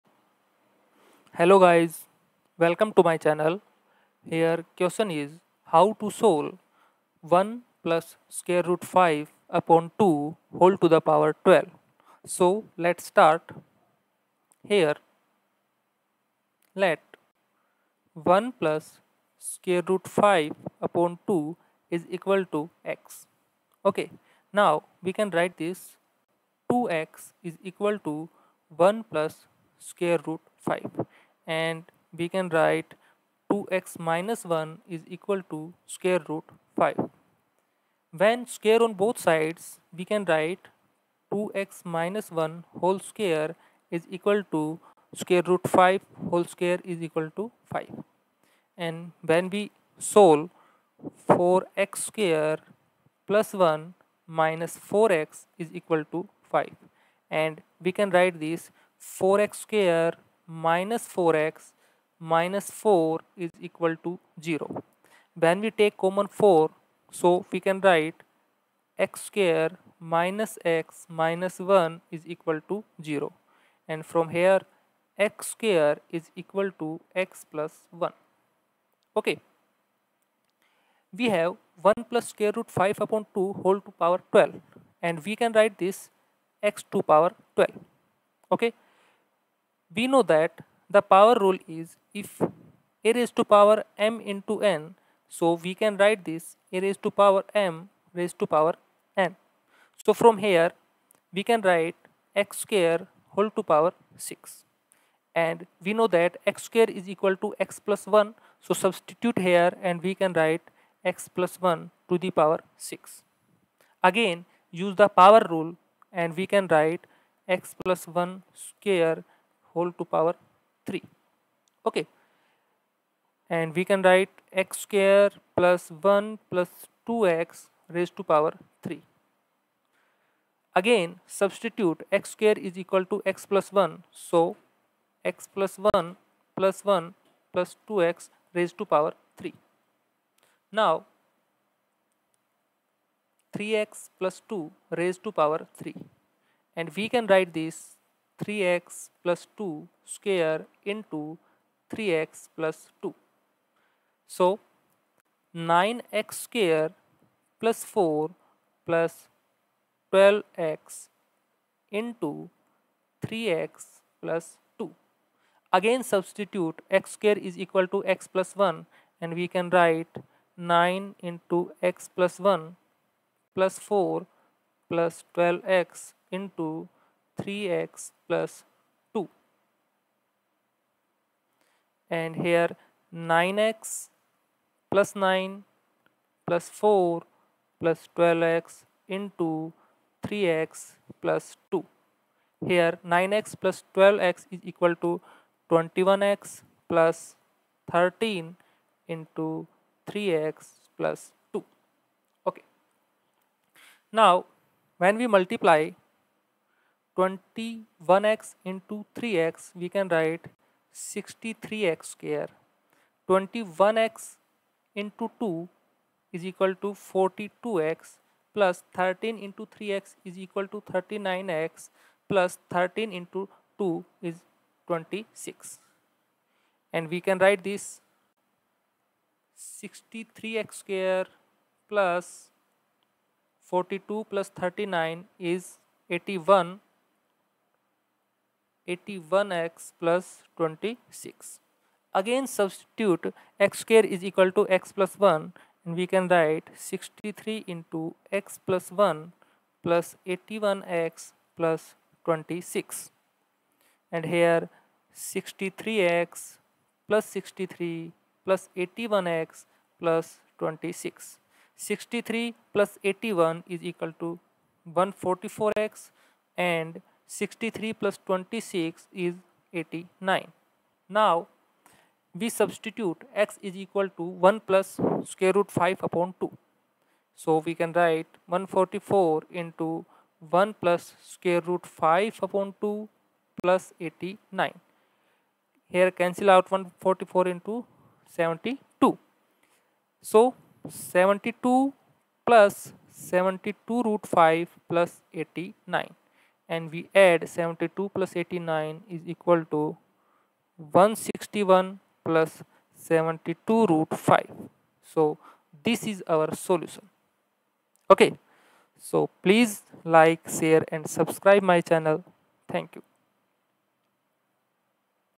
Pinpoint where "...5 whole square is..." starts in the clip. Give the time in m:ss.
0:45.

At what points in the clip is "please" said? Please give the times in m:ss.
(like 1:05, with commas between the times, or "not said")
5:09.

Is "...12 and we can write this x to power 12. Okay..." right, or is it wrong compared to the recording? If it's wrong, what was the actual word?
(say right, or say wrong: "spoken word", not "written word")
right.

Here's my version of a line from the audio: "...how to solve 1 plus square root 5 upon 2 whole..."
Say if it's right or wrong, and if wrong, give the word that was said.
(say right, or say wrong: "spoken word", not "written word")
right.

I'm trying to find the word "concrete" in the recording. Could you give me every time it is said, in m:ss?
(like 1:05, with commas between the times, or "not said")
not said.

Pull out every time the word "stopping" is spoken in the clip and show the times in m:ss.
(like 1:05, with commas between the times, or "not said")
not said.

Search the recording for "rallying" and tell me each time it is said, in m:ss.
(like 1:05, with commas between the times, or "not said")
not said.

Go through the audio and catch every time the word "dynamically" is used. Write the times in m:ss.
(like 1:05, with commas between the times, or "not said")
not said.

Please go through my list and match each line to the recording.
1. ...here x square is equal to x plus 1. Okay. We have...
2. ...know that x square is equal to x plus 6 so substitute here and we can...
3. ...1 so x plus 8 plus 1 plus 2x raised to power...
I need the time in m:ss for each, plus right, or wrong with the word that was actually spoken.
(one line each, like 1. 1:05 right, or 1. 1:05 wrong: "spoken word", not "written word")
1. 1:14 right
2. 1:45 wrong: "1", not "6"
3. 2:13 wrong: "1", not "8".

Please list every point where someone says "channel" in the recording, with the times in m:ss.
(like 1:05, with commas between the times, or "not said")
0:03, 5:11.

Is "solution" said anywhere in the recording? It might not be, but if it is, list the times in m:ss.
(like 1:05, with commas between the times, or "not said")
5:06.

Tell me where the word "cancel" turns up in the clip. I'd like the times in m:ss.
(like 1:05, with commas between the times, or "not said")
4:46.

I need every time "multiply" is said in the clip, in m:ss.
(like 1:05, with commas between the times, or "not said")
3:25.